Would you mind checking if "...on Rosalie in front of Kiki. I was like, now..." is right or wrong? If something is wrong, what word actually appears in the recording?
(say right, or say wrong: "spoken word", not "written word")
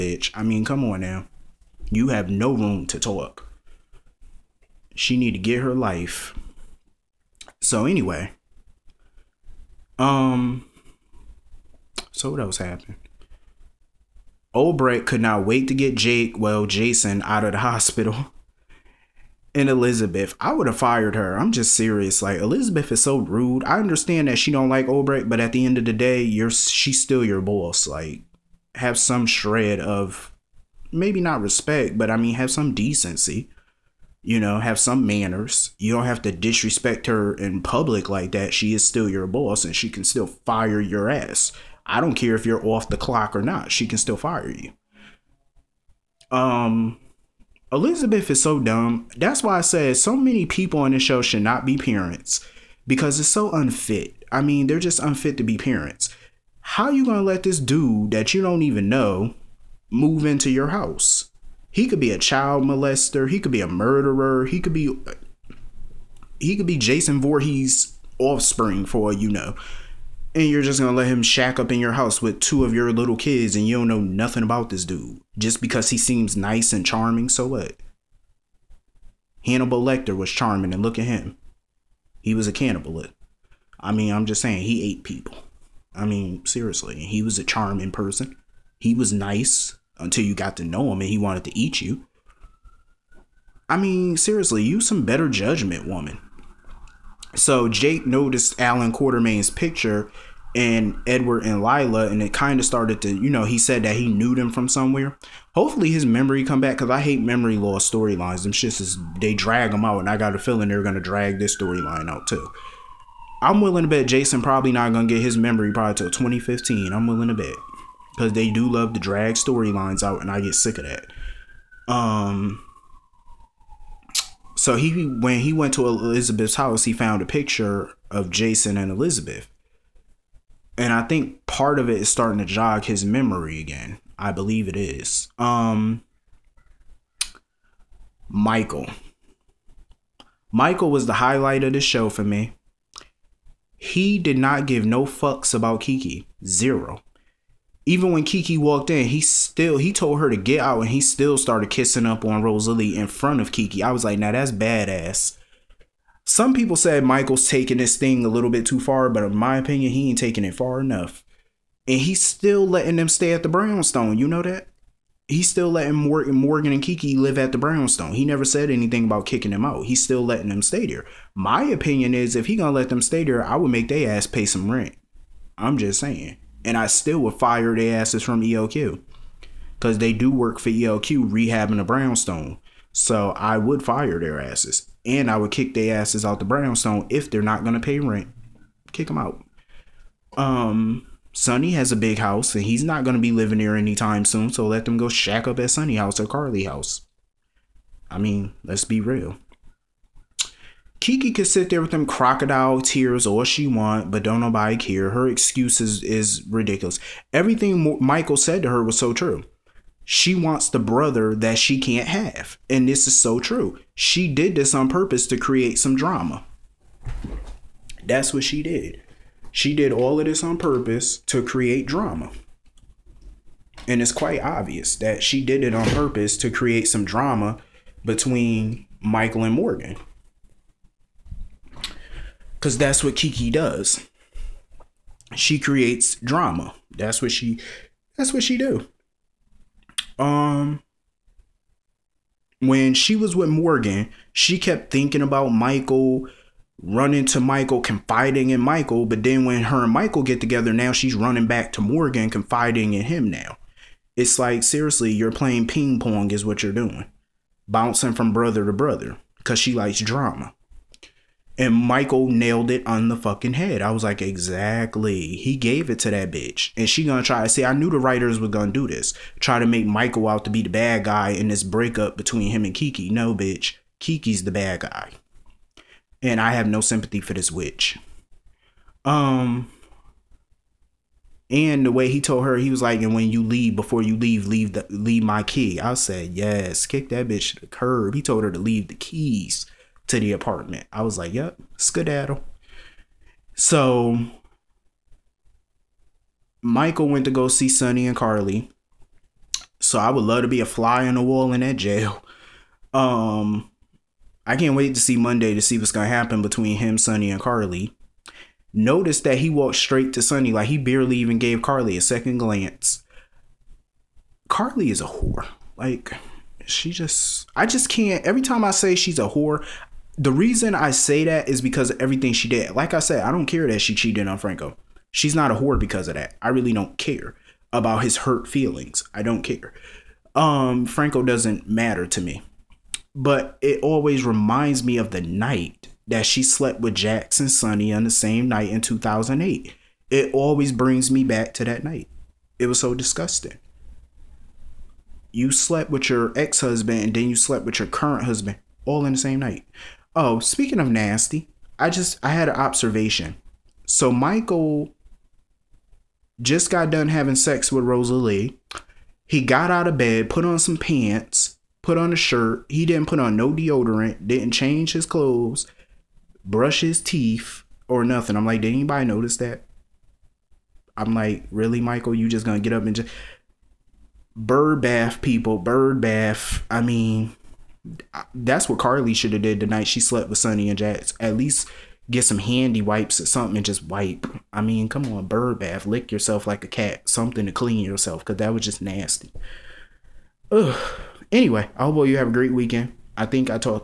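right.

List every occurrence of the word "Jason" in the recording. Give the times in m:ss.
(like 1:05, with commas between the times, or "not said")
0:16, 1:06, 1:54, 2:08.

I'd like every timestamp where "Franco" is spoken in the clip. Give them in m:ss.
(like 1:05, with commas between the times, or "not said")
5:24, 5:30.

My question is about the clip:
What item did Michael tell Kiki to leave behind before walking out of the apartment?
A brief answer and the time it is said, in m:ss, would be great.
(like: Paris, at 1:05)
Key, at 4:45.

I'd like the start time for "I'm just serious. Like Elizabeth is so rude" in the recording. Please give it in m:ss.
0:21.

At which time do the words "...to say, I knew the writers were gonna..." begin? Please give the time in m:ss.
4:27.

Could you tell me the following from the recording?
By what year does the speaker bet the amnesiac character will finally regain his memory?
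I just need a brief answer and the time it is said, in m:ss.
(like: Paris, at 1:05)
2015, at 1:56.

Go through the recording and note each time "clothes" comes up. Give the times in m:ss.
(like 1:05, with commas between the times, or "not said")
6:05.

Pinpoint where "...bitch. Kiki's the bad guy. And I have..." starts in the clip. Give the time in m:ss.
4:33.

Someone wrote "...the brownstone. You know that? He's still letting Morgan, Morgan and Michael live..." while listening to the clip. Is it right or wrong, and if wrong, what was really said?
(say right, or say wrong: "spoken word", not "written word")
wrong: "Kiki", not "Michael".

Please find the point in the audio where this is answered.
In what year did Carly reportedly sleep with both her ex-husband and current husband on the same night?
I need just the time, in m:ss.
5:38.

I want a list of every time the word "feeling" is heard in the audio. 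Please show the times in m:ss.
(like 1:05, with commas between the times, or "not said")
1:50, 5:28.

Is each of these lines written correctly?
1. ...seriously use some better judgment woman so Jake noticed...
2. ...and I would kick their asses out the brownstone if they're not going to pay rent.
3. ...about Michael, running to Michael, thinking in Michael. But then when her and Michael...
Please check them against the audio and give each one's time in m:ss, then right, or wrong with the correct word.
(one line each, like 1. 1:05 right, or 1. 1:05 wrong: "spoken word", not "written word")
1. 1:34 right
2. 3:05 right
3. 4:05 wrong: "confiding", not "thinking".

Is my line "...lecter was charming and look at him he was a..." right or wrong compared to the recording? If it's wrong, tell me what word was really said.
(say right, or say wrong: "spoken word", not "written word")
right.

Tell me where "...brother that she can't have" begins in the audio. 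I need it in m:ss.
3:30.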